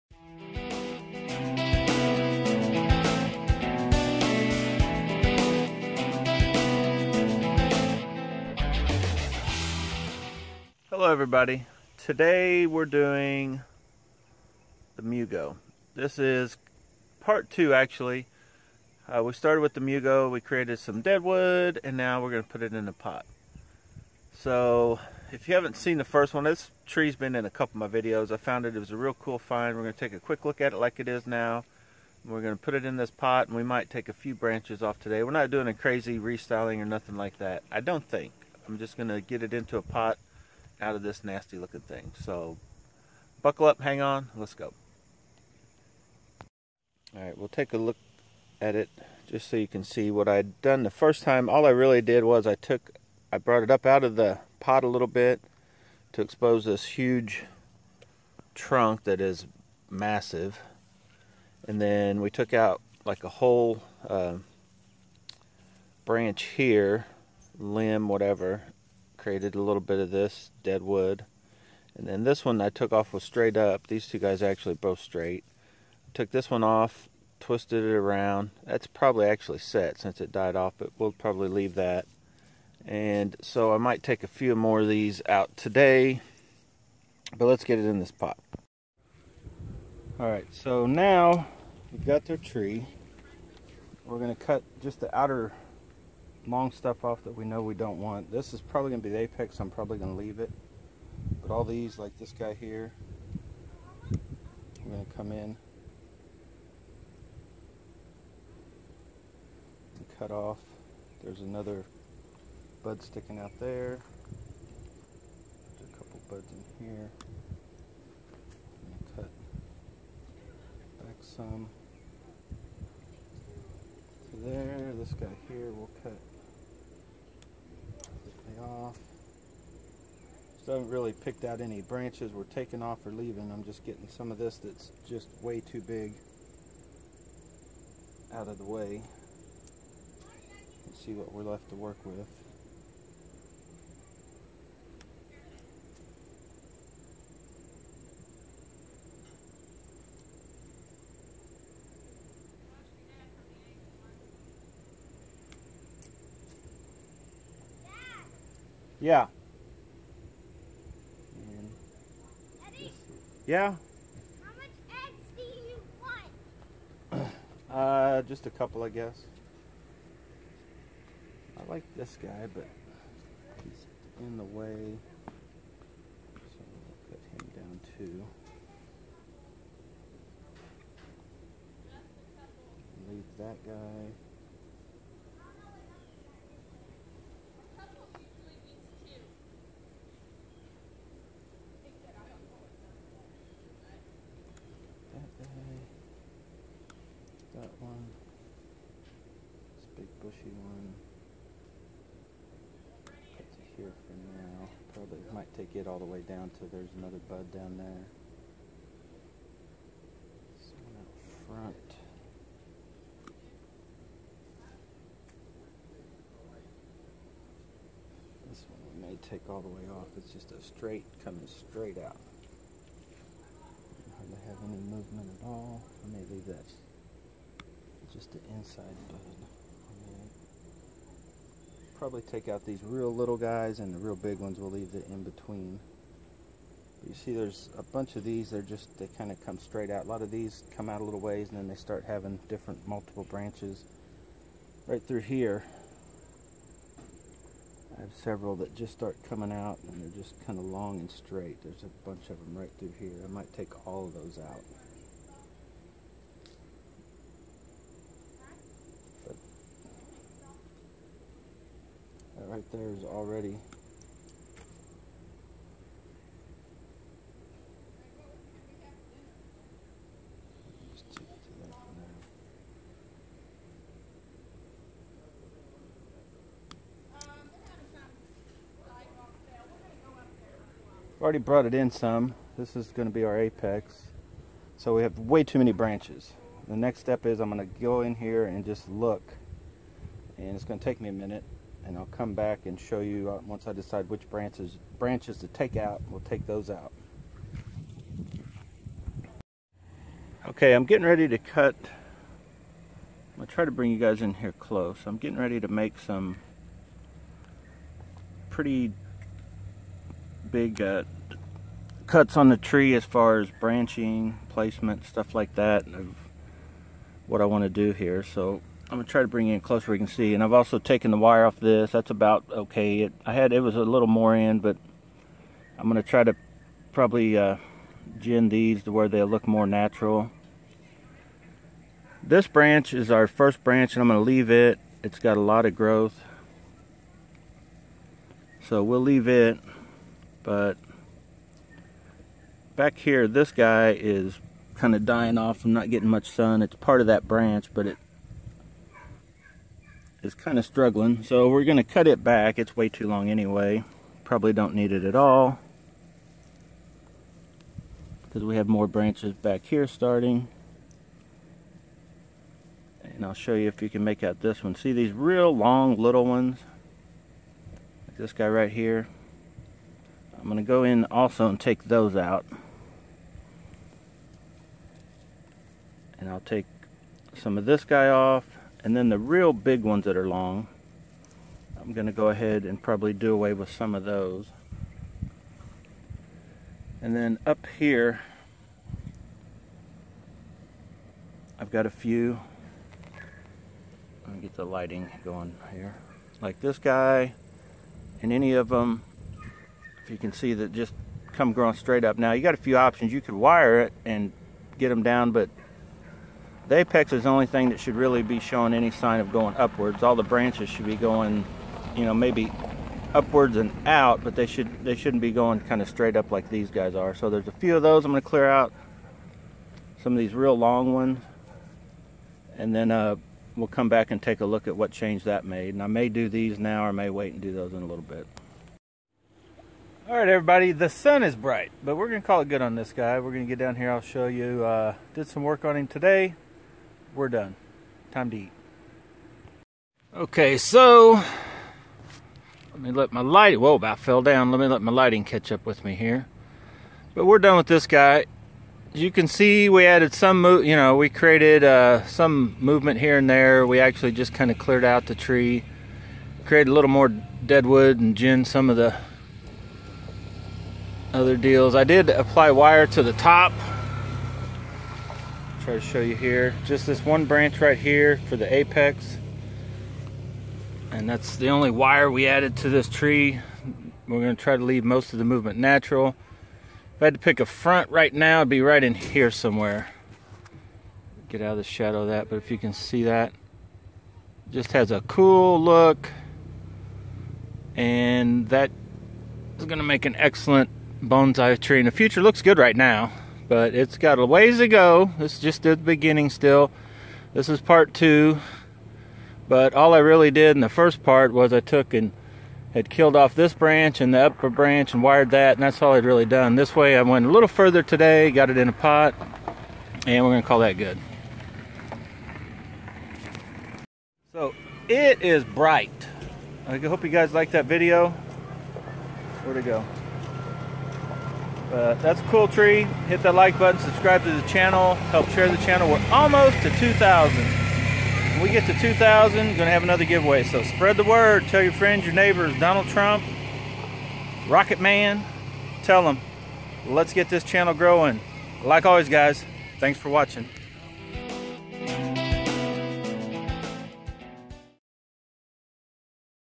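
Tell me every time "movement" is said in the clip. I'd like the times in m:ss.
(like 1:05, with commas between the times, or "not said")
3:44, 7:32, 7:55.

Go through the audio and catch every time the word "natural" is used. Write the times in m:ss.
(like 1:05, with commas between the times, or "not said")
5:29, 7:55.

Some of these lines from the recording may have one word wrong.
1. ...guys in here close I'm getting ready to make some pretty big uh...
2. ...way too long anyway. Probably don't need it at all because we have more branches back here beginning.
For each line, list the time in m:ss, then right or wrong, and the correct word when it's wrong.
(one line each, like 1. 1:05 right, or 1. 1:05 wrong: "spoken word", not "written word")
1. 5:03 right
2. 5:52 wrong: "starting", not "beginning".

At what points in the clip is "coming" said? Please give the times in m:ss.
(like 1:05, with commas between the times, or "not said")
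3:41, 4:09.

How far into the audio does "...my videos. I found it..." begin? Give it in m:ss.
0:27.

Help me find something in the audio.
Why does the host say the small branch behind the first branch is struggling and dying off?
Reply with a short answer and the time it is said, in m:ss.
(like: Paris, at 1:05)
not getting much sun, at 5:45.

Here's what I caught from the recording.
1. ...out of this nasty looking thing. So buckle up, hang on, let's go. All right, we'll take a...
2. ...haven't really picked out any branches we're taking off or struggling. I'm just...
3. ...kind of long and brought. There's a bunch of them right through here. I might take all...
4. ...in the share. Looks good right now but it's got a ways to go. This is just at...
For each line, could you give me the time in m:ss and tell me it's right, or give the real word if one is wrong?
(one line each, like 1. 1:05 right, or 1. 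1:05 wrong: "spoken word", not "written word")
1. 0:40 right
2. 2:10 wrong: "leaving", not "struggling"
3. 4:10 wrong: "straight", not "brought"
4. 8:11 wrong: "future", not "share".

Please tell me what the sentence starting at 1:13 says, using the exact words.
These two guys actually both straight.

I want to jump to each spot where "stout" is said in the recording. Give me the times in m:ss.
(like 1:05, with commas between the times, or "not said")
not said.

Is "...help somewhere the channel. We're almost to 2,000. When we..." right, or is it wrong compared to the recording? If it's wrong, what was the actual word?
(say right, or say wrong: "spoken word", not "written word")
wrong: "share", not "somewhere".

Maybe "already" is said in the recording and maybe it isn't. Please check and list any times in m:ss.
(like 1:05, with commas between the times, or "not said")
4:23, 4:41.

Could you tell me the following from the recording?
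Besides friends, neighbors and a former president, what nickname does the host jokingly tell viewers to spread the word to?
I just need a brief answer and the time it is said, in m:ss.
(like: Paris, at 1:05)
Rocket Man, at 8:54.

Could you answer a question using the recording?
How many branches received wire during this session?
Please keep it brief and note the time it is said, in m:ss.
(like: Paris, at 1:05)
1, at 7:46.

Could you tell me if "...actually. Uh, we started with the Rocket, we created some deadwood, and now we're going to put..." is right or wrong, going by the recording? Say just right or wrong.
wrong.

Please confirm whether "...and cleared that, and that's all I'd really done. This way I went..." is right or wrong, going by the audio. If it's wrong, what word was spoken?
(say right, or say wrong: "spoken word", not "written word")
wrong: "wired", not "cleared".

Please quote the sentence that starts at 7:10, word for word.
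All right, everybody, the sun is bright, but we're going to call it good on this guy.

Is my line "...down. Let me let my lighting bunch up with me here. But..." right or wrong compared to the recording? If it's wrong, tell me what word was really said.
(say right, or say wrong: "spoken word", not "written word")
wrong: "catch", not "bunch".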